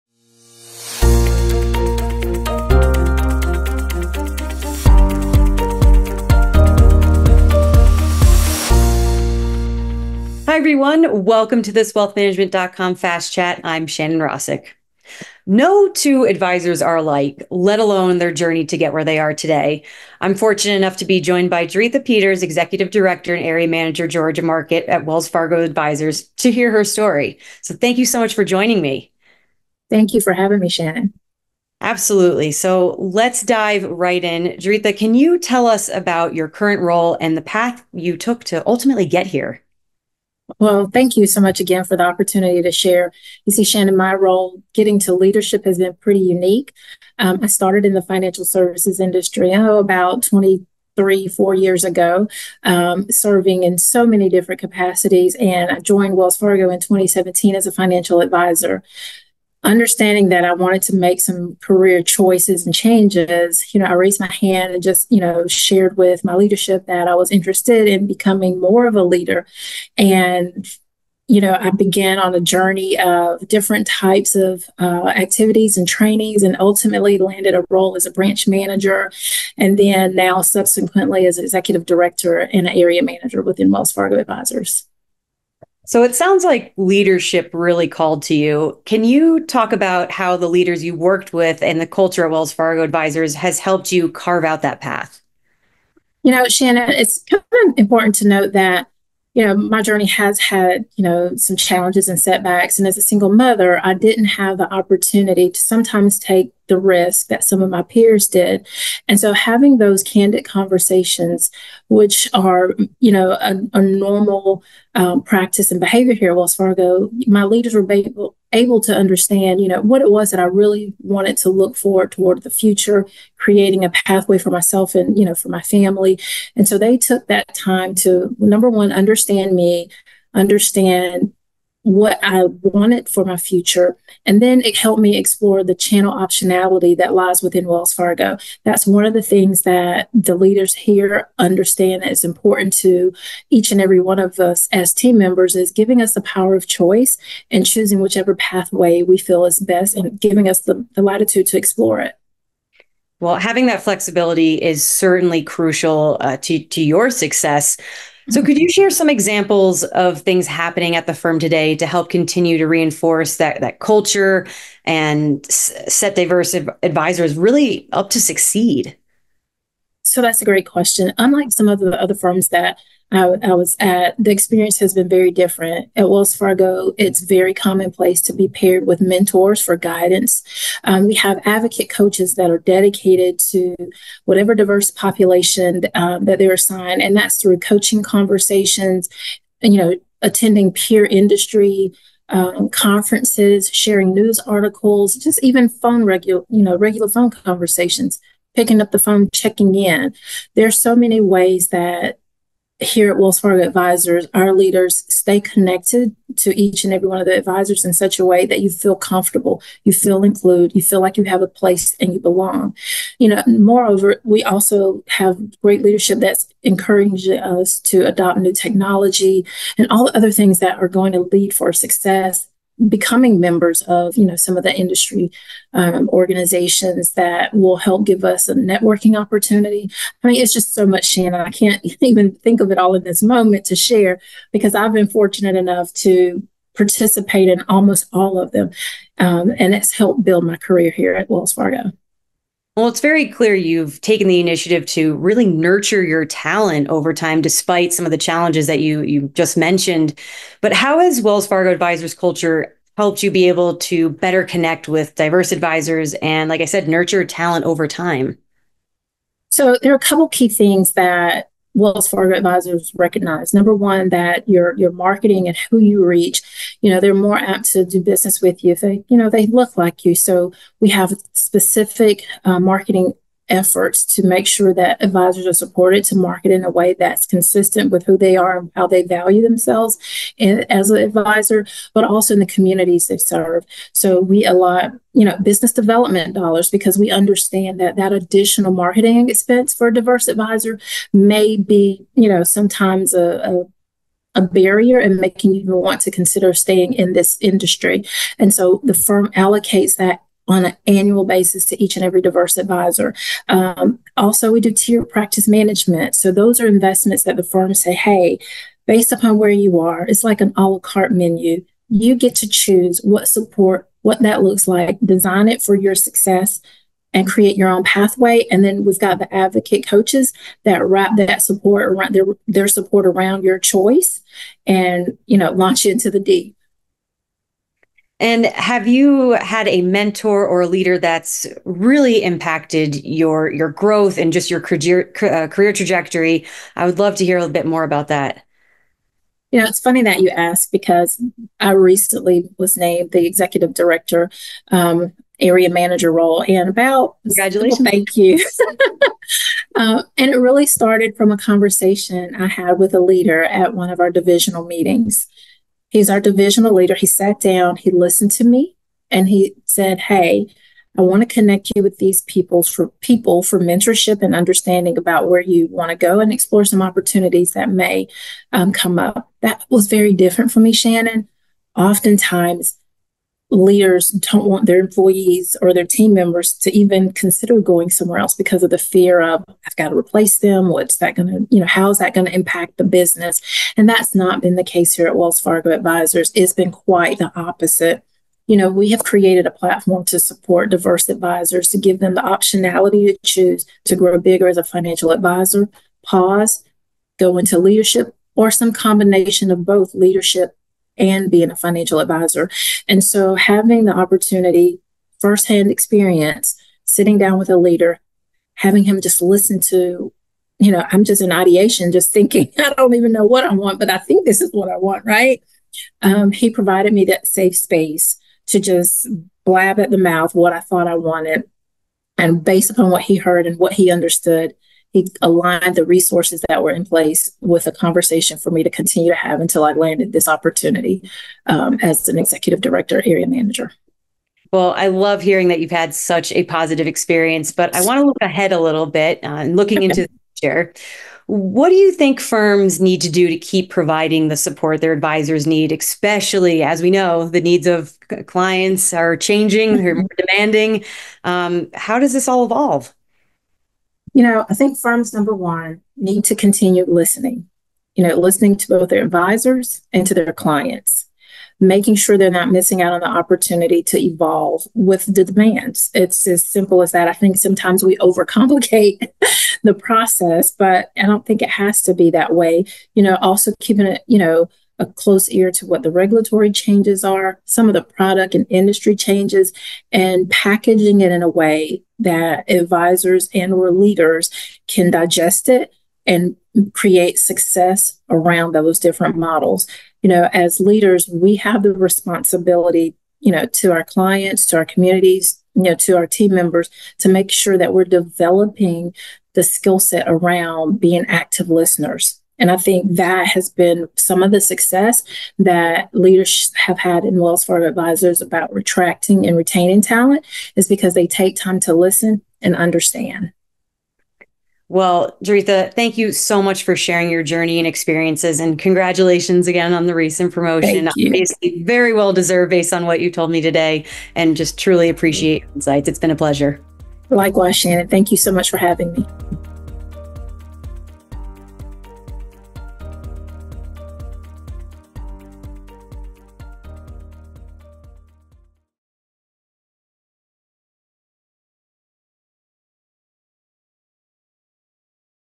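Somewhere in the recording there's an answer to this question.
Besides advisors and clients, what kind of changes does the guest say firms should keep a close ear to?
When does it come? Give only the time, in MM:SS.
07:55.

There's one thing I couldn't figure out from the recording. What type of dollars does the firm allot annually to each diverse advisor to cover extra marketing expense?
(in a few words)
business development dollars.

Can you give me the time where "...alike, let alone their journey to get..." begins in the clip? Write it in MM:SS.
00:16.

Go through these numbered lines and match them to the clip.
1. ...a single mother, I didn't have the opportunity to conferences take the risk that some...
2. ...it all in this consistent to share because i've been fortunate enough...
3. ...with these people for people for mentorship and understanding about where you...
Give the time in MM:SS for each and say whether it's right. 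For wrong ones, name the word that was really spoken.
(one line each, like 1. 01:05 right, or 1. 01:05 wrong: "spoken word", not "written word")
1. 01:42 wrong: "sometimes", not "conferences"
2. 03:52 wrong: "moment", not "consistent"
3. 06:01 right.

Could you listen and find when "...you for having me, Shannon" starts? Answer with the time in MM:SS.
00:30.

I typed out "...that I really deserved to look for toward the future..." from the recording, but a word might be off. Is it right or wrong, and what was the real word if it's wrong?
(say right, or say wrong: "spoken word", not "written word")
wrong: "wanted", not "deserved".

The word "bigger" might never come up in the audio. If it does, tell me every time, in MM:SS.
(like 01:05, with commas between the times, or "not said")
06:34.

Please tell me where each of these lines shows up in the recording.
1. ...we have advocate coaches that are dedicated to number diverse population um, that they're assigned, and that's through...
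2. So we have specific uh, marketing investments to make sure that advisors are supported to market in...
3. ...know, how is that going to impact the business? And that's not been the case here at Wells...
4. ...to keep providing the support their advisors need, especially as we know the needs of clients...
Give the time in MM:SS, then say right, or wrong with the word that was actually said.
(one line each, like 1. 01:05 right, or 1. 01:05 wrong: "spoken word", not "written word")
1. 03:01 wrong: "whatever", not "number"
2. 04:30 wrong: "efforts", not "investments"
3. 06:21 right
4. 07:23 right.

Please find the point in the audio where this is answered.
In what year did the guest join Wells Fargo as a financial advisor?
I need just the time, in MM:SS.
00:56.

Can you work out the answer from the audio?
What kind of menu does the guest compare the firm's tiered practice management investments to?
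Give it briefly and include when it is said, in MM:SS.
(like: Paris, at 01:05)
a la carte menu, at 05:10.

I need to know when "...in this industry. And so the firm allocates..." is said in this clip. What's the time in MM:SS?
04:56.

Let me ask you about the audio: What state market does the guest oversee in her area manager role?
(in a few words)
Georgia.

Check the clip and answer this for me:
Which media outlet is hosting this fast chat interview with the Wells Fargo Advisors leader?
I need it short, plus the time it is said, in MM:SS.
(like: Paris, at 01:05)
wealthmanagement.com, at 00:11.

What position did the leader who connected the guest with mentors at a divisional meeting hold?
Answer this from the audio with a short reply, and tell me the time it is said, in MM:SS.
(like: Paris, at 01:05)
divisional leader, at 05:56.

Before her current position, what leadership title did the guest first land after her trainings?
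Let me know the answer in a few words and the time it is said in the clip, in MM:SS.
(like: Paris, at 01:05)
branch manager, at 01:18.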